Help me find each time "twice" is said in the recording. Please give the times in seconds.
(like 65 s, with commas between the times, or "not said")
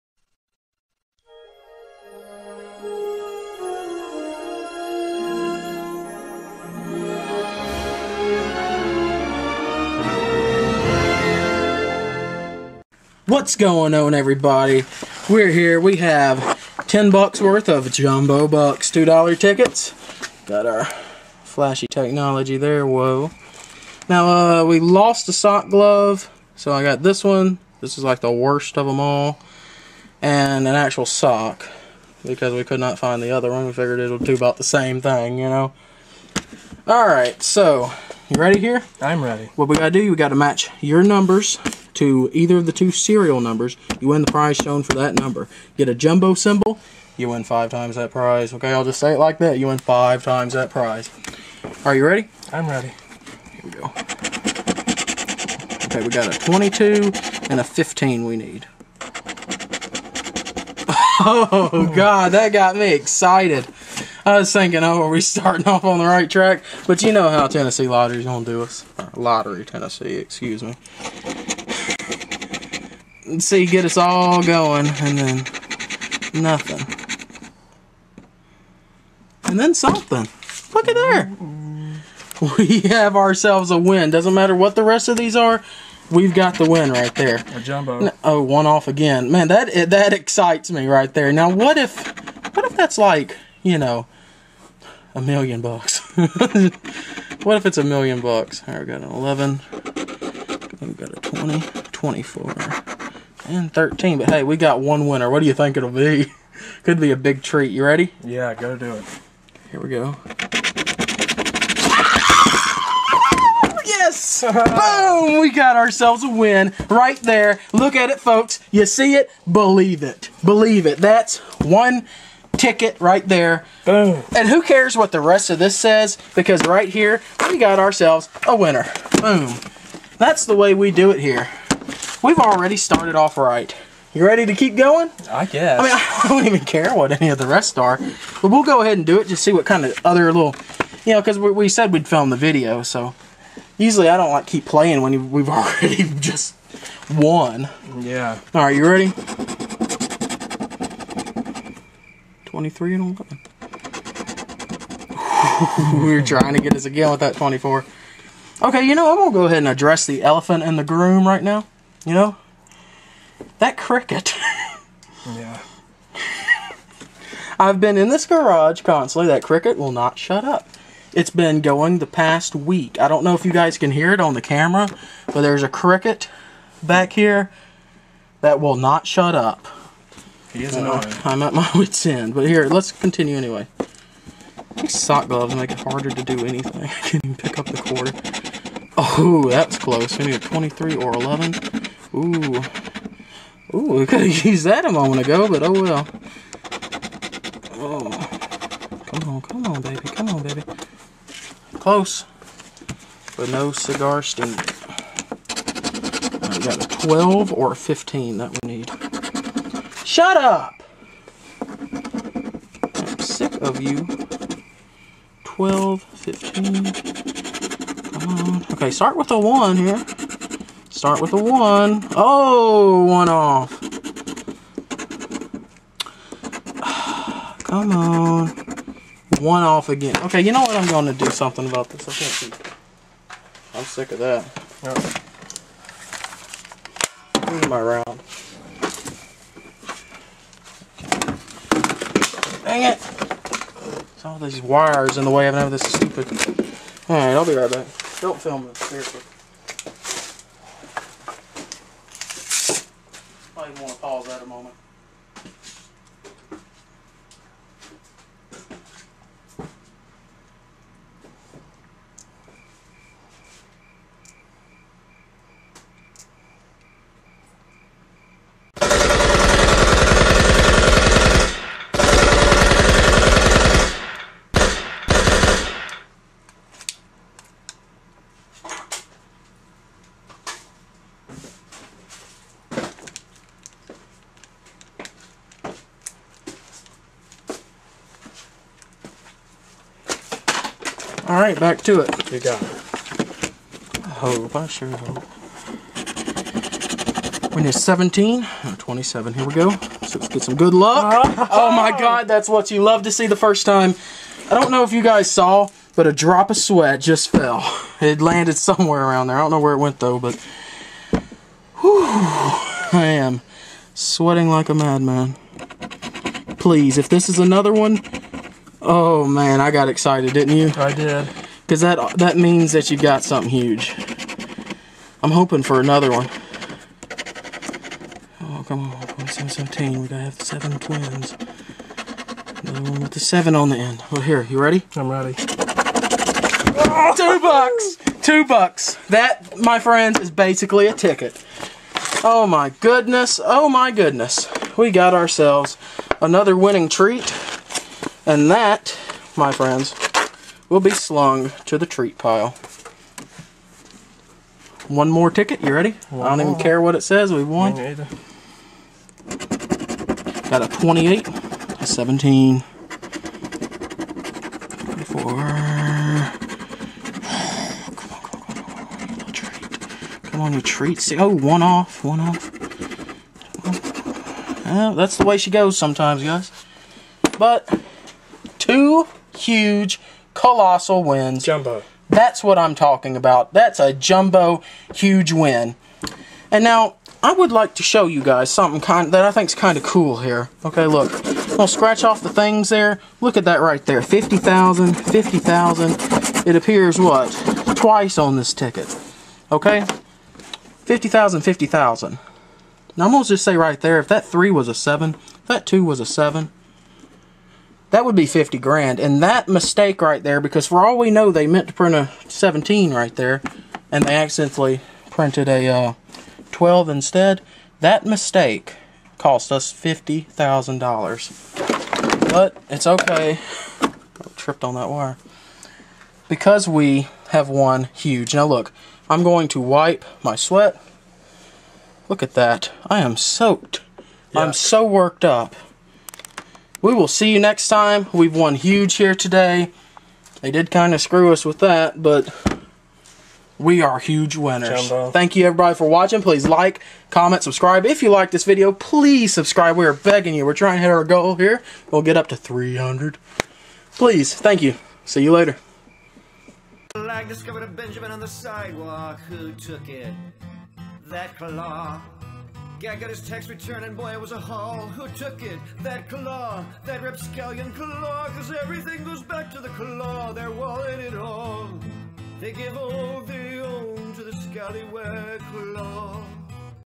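397 s.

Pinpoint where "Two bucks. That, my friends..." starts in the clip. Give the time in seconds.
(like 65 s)
338 s.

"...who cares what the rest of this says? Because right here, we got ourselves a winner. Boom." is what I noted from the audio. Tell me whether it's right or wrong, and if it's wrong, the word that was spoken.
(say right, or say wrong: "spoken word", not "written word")
right.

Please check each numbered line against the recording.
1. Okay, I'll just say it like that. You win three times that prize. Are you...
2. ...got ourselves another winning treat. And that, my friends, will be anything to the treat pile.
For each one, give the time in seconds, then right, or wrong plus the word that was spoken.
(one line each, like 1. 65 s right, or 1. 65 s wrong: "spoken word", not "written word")
1. 48 s wrong: "five", not "three"
2. 344 s wrong: "slung", not "anything".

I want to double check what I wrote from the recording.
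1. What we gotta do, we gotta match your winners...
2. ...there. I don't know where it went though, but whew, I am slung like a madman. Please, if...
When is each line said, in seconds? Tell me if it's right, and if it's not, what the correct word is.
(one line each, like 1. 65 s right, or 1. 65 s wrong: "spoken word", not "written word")
1. 39 s wrong: "numbers", not "winners"
2. 309 s wrong: "sweating", not "slung".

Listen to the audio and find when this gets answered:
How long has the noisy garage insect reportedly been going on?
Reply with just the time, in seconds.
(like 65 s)
171 s.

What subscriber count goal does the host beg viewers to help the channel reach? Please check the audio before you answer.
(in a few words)
300.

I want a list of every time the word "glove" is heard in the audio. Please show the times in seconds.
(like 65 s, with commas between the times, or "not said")
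25 s, 185 s.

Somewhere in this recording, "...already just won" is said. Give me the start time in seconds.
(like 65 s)
145 s.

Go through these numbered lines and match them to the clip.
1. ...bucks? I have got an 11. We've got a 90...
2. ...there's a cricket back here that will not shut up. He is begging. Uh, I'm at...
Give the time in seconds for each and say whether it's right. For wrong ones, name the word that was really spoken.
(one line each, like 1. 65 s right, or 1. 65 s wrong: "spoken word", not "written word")
1. 98 s wrong: "20", not "90"
2. 175 s wrong: "annoying", not "begging".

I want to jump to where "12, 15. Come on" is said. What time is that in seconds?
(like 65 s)
215 s.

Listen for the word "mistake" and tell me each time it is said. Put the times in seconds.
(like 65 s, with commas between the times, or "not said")
409 s, 418 s.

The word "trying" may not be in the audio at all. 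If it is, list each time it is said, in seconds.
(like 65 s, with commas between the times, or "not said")
156 s, 450 s.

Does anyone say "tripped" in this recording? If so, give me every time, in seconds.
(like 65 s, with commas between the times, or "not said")
424 s.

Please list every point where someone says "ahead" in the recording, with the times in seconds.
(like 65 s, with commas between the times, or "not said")
138 s, 159 s.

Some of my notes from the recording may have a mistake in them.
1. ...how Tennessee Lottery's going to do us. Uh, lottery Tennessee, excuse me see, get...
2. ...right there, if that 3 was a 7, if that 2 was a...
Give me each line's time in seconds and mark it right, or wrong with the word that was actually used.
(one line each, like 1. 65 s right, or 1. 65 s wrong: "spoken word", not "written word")
1. 67 s right
2. 403 s right.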